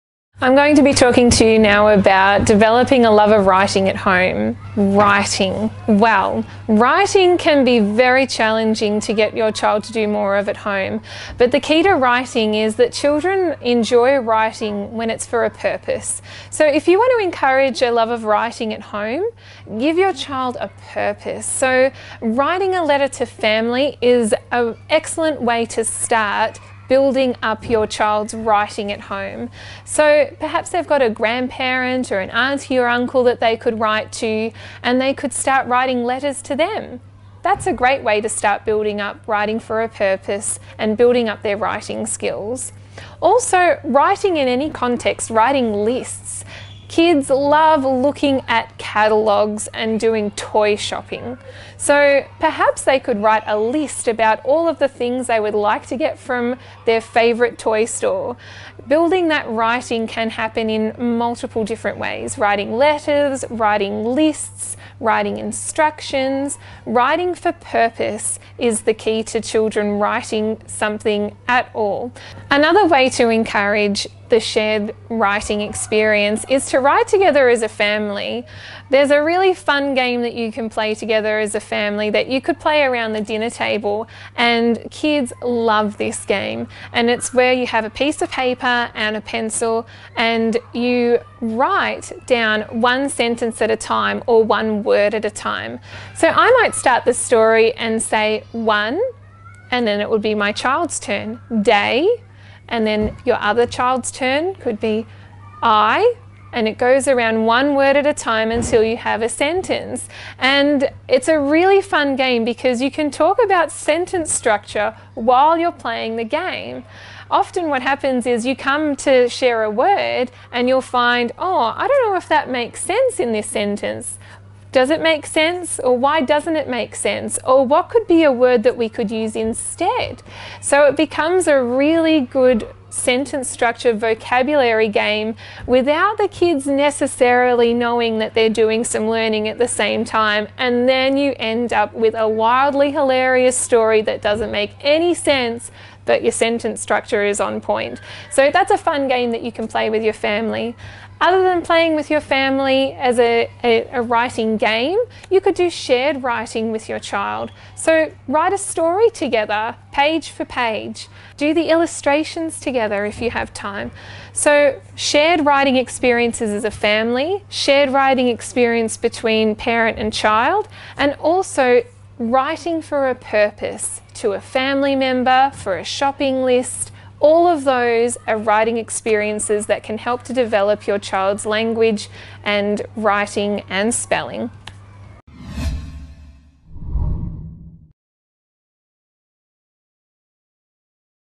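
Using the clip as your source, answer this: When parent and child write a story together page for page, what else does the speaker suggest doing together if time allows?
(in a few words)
Illustrations.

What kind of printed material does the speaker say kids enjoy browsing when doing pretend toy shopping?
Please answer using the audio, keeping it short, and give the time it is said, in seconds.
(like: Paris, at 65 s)
Catalogues, at 48 s.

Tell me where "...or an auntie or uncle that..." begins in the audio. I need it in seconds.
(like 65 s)
32 s.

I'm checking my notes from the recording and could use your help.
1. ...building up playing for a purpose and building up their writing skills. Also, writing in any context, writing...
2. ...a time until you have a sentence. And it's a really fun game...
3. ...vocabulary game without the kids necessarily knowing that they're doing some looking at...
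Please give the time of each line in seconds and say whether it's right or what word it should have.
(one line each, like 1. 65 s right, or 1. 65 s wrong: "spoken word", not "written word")
1. 38 s wrong: "writing", not "playing"
2. 108 s right
3. 133 s wrong: "learning", not "looking".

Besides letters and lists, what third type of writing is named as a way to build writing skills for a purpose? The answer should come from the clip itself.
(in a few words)
Instructions.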